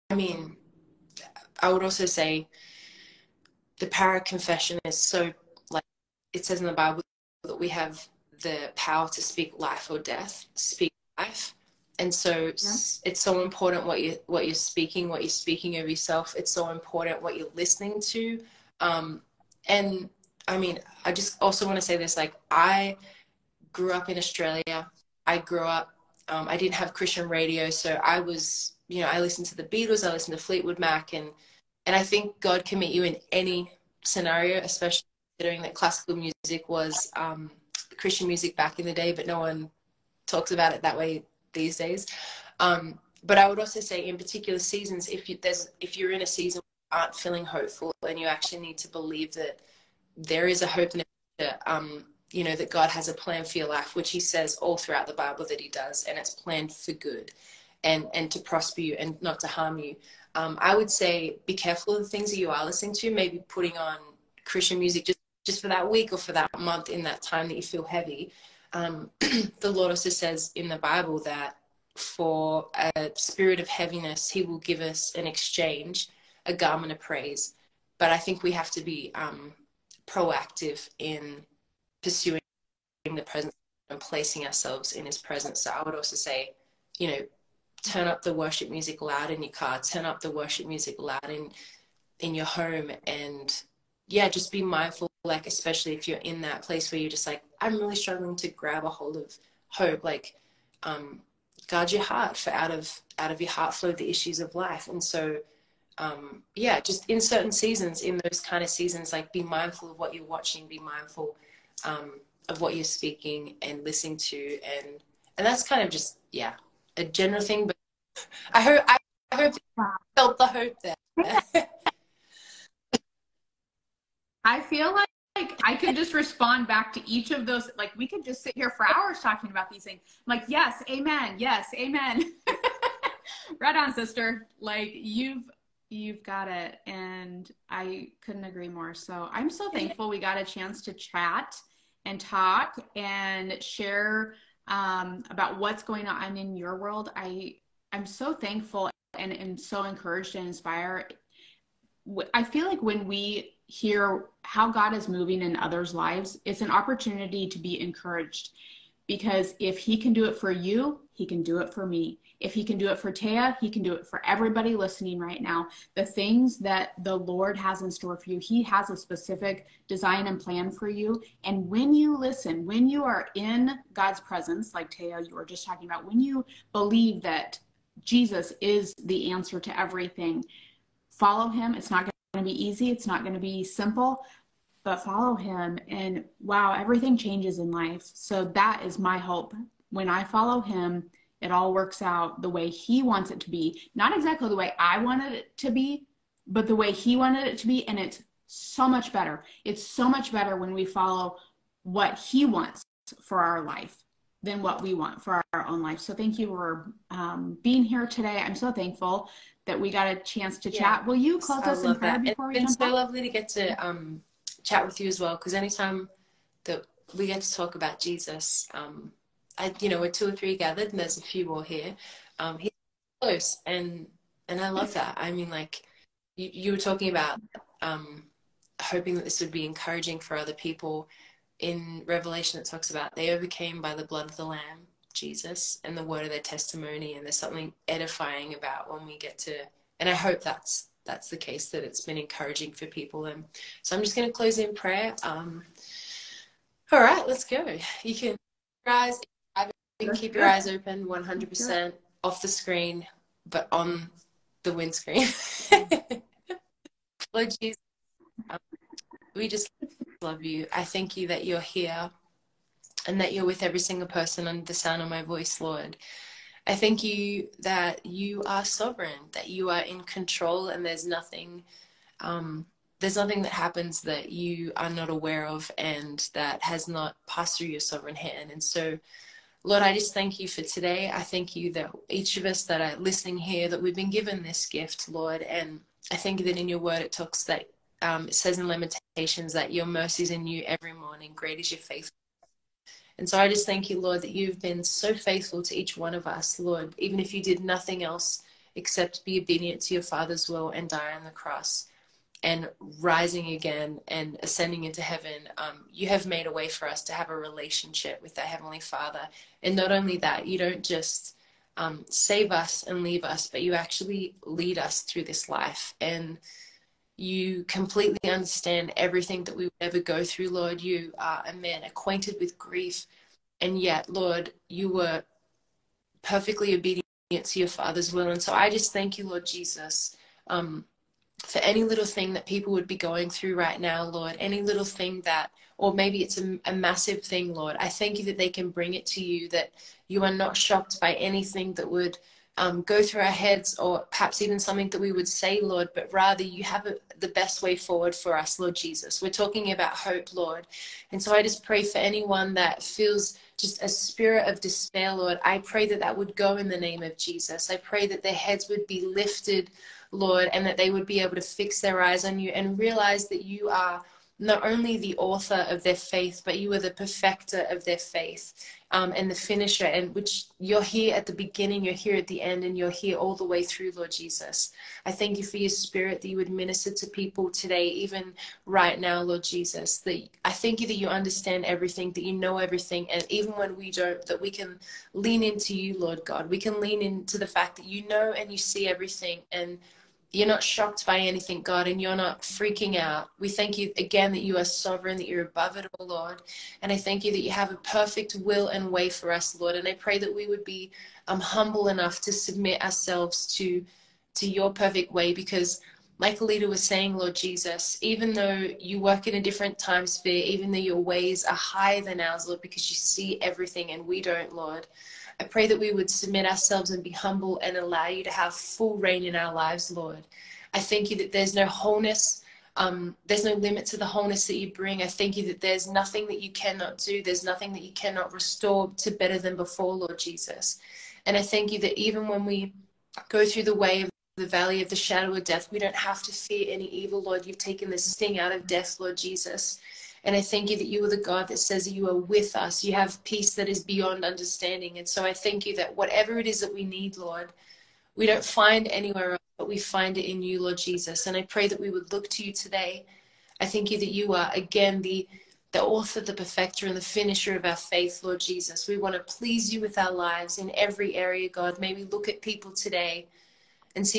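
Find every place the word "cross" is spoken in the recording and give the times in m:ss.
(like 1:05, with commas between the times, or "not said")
5:01.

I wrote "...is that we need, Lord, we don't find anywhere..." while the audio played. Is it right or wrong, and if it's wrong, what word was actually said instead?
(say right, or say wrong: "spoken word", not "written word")
right.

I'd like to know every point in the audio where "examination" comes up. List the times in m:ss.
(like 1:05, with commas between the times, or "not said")
not said.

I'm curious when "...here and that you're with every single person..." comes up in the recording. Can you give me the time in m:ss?
4:21.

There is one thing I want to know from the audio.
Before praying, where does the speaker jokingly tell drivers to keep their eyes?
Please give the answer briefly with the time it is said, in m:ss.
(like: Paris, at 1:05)
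On the windscreen, at 4:13.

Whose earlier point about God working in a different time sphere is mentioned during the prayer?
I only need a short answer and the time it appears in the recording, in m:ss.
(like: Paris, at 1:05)
Alita, at 6:46.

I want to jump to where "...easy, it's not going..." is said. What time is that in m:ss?
3:02.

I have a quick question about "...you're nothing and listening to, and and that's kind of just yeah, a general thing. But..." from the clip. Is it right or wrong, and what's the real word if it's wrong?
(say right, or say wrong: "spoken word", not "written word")
wrong: "speaking", not "nothing".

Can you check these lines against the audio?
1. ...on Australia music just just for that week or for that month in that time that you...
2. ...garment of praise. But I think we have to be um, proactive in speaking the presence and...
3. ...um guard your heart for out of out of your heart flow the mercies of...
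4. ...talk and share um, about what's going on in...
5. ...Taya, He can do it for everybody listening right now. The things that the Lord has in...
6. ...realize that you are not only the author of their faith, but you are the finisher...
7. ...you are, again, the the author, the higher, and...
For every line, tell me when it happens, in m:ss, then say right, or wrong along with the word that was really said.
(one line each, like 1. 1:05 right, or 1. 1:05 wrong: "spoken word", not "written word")
1. 1:03 wrong: "Christian", not "Australia"
2. 1:16 wrong: "pursuing", not "speaking"
3. 1:40 wrong: "issues", not "mercies"
4. 2:22 right
5. 2:43 right
6. 6:02 wrong: "perfecter", not "finisher"
7. 7:34 wrong: "perfecter", not "higher".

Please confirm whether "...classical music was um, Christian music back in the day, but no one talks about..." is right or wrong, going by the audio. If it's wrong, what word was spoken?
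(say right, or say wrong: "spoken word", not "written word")
right.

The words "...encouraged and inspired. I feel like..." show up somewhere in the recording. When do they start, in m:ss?
2:29.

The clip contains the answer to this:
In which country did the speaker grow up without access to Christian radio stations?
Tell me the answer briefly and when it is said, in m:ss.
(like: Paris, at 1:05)
Australia, at 0:24.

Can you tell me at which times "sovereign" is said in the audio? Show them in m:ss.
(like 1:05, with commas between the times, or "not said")
4:28, 4:37, 6:34.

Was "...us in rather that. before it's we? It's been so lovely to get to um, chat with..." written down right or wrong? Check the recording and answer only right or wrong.
wrong.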